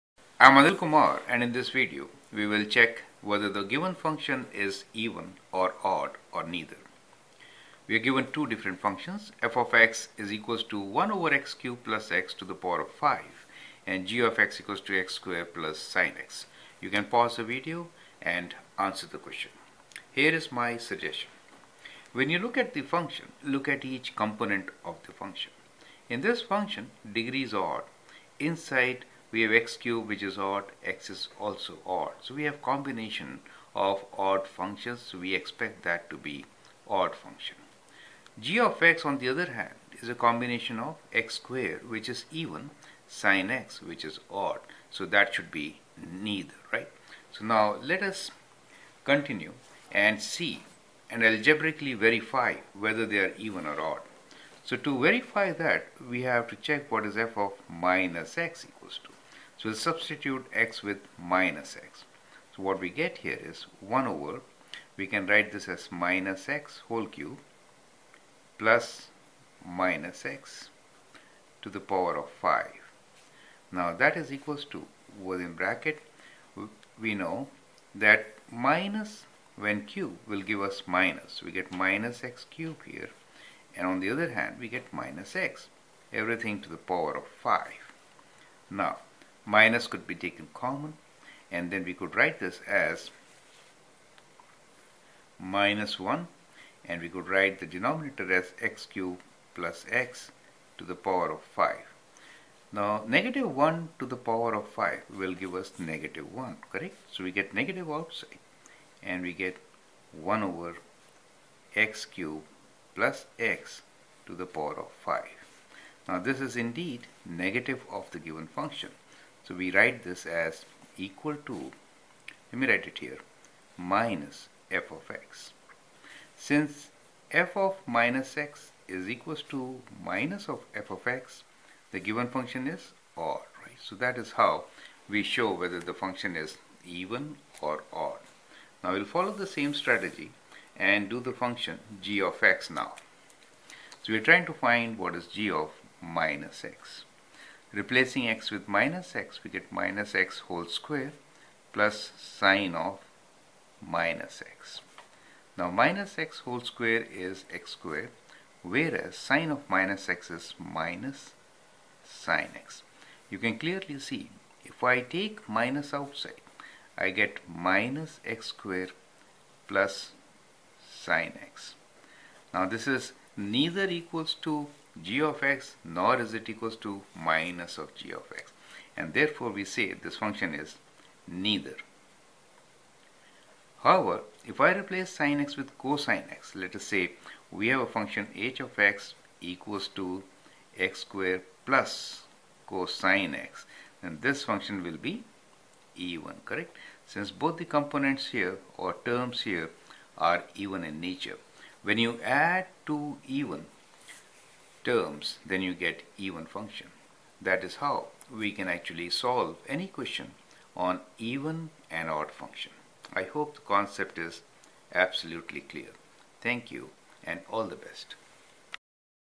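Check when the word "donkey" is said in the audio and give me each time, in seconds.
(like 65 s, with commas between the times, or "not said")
not said.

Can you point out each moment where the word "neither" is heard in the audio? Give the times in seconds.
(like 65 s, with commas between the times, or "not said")
6 s, 46 s, 173 s, 181 s.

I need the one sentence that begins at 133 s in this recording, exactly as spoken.
So that is how we show whether the function is even or odd.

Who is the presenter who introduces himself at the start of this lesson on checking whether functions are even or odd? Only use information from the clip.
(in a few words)
Anil Kumar.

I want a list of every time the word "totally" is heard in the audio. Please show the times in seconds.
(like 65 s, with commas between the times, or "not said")
not said.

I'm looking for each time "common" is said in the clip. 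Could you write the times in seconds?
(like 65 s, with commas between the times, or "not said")
90 s.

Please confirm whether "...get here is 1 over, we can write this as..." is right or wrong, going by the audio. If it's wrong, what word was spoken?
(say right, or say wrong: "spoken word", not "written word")
right.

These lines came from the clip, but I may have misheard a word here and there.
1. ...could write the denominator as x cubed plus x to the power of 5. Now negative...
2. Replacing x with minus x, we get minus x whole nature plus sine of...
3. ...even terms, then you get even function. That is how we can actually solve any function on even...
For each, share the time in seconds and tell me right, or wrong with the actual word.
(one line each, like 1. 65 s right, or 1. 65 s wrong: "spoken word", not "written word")
1. 97 s right
2. 147 s wrong: "square", not "nature"
3. 203 s wrong: "question", not "function".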